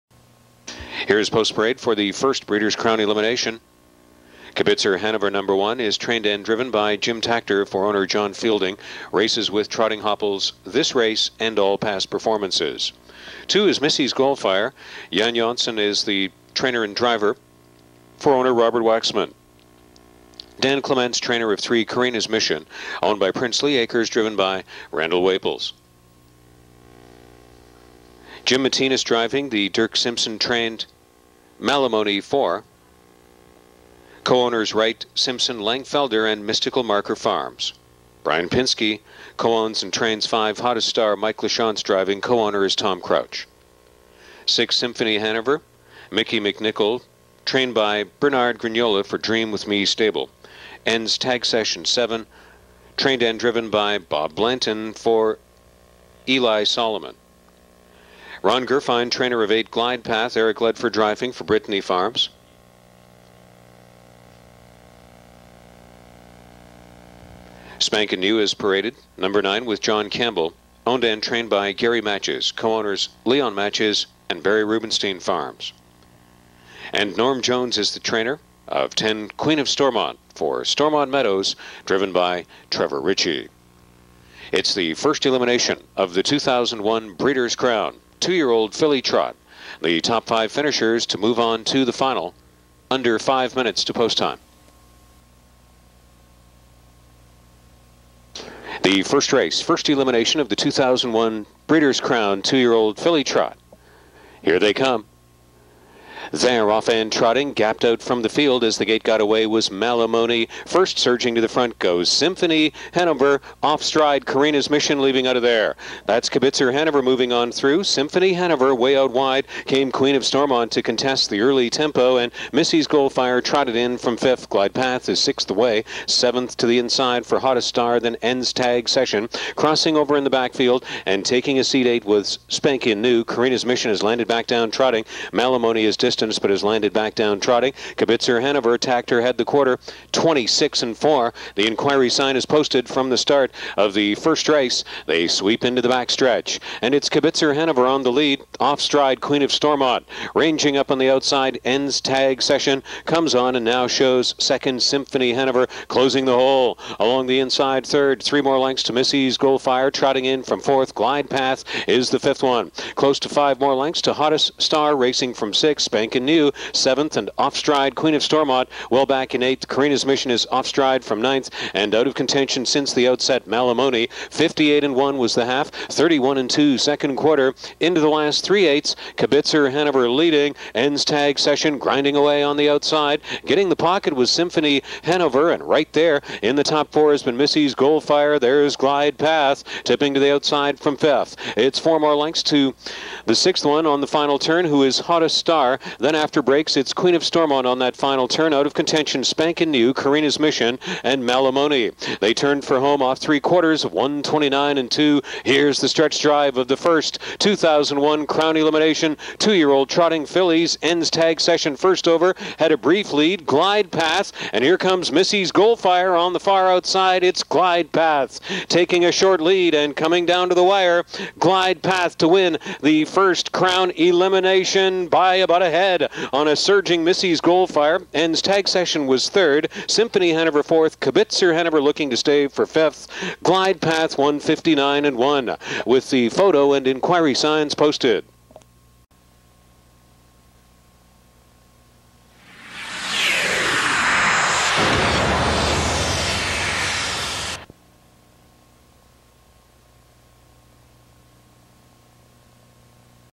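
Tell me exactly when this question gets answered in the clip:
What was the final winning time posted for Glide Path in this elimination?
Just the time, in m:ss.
3:54.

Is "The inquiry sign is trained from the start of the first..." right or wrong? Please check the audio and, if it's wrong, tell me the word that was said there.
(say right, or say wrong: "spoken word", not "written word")
wrong: "posted", not "trained".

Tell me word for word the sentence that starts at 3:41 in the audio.
Glide path to win the first Crown Elimination by about a head ahead on a surging Missy's Goldfire.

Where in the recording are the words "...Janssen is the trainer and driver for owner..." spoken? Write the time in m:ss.
0:15.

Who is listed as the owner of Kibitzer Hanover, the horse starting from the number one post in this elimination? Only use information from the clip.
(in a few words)
John Fielding.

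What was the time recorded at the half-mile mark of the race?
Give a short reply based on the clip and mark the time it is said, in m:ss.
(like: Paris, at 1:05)
58 and 1, at 2:54.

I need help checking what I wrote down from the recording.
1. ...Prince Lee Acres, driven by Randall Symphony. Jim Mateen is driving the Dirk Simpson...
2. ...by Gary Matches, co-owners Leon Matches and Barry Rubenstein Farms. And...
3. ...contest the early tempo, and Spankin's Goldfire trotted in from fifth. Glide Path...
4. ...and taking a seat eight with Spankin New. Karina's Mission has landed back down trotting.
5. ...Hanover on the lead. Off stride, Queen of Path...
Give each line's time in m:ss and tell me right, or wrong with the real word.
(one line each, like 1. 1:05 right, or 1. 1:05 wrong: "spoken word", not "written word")
1. 0:23 wrong: "Waples", not "Symphony"
2. 1:11 right
3. 2:00 wrong: "Missy", not "Spankin"
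4. 2:11 right
5. 2:27 wrong: "Stormont", not "Path".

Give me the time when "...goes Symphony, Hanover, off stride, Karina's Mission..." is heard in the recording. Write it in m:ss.
1:51.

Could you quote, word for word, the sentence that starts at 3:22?
They turned for home off three quarters, 129 and 2.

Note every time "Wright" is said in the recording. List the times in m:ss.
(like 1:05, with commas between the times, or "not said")
0:34.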